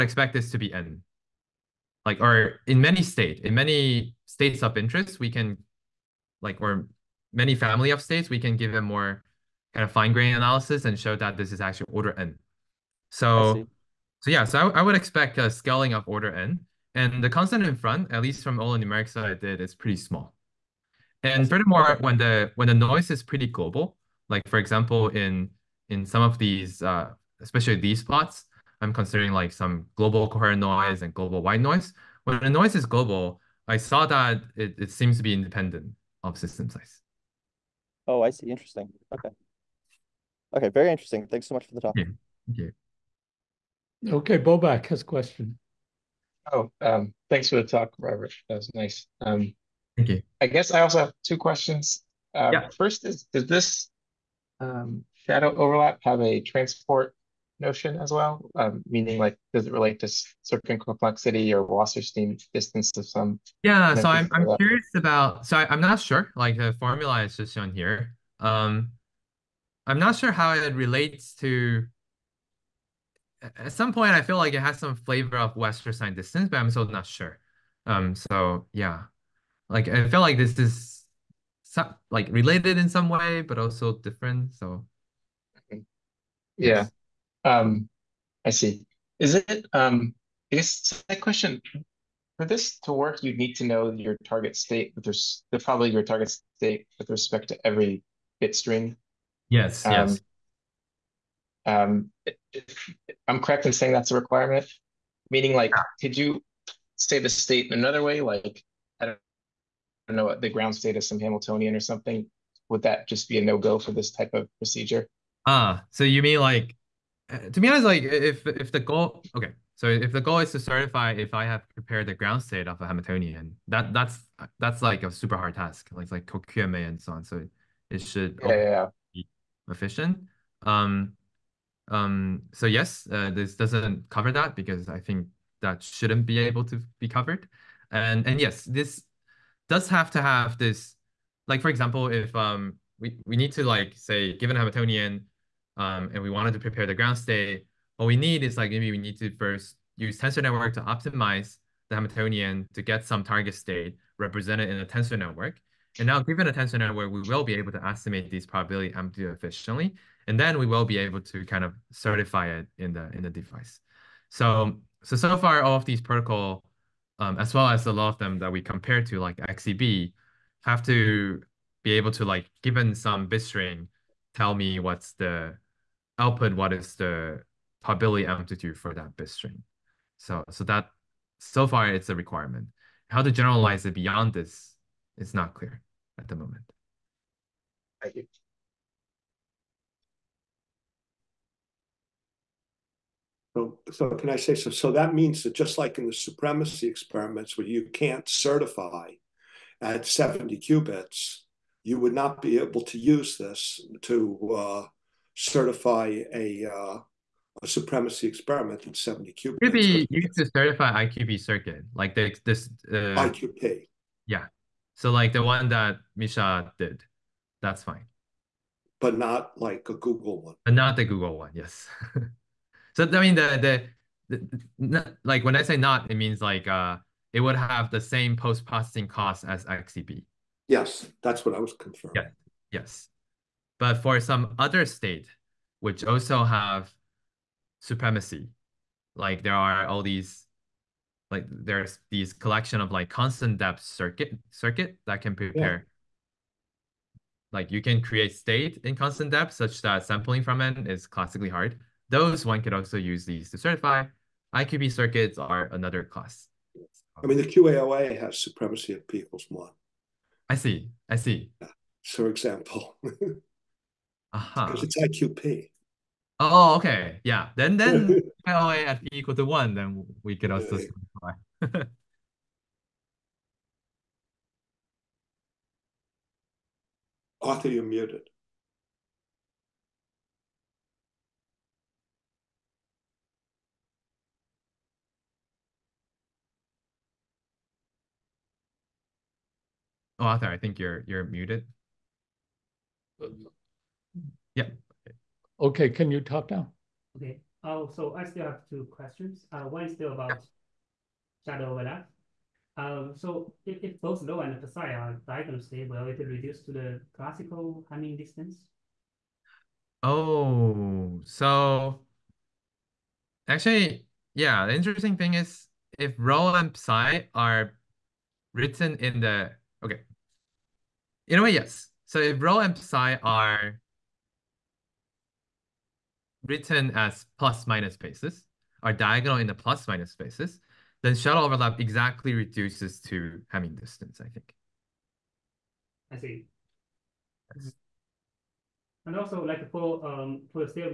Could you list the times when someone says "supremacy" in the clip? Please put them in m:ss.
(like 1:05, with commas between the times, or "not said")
3:16, 3:27, 3:57, 4:18.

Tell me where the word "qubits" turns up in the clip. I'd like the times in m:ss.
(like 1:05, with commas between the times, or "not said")
3:20, 3:29.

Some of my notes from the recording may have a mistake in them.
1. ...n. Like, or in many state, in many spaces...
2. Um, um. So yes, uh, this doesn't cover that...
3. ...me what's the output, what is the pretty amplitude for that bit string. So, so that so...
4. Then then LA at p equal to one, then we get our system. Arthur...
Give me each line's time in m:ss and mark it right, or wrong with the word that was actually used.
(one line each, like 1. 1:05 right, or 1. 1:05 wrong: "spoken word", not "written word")
1. 0:00 wrong: "states", not "spaces"
2. 2:10 right
3. 2:54 wrong: "probability", not "pretty"
4. 4:27 right.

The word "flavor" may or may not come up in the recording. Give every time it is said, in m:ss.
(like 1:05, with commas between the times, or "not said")
1:14.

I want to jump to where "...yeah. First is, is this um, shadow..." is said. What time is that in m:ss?
0:52.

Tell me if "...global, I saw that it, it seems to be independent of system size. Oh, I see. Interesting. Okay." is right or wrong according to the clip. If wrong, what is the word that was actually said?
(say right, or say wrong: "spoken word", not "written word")
right.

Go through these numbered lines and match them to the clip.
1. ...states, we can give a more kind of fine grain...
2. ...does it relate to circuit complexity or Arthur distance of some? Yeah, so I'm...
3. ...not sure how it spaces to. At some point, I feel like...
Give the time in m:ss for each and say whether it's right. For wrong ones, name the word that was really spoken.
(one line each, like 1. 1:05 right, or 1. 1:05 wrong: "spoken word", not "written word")
1. 0:08 right
2. 0:59 wrong: "Wasserstein", not "Arthur"
3. 1:09 wrong: "relates", not "spaces".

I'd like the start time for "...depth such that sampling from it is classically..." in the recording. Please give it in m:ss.
4:09.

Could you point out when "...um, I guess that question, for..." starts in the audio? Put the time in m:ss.
1:29.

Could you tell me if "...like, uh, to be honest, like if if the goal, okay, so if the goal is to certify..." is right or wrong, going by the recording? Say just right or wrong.
right.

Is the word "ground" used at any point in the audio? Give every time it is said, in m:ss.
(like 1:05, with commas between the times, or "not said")
1:50, 2:02, 2:26.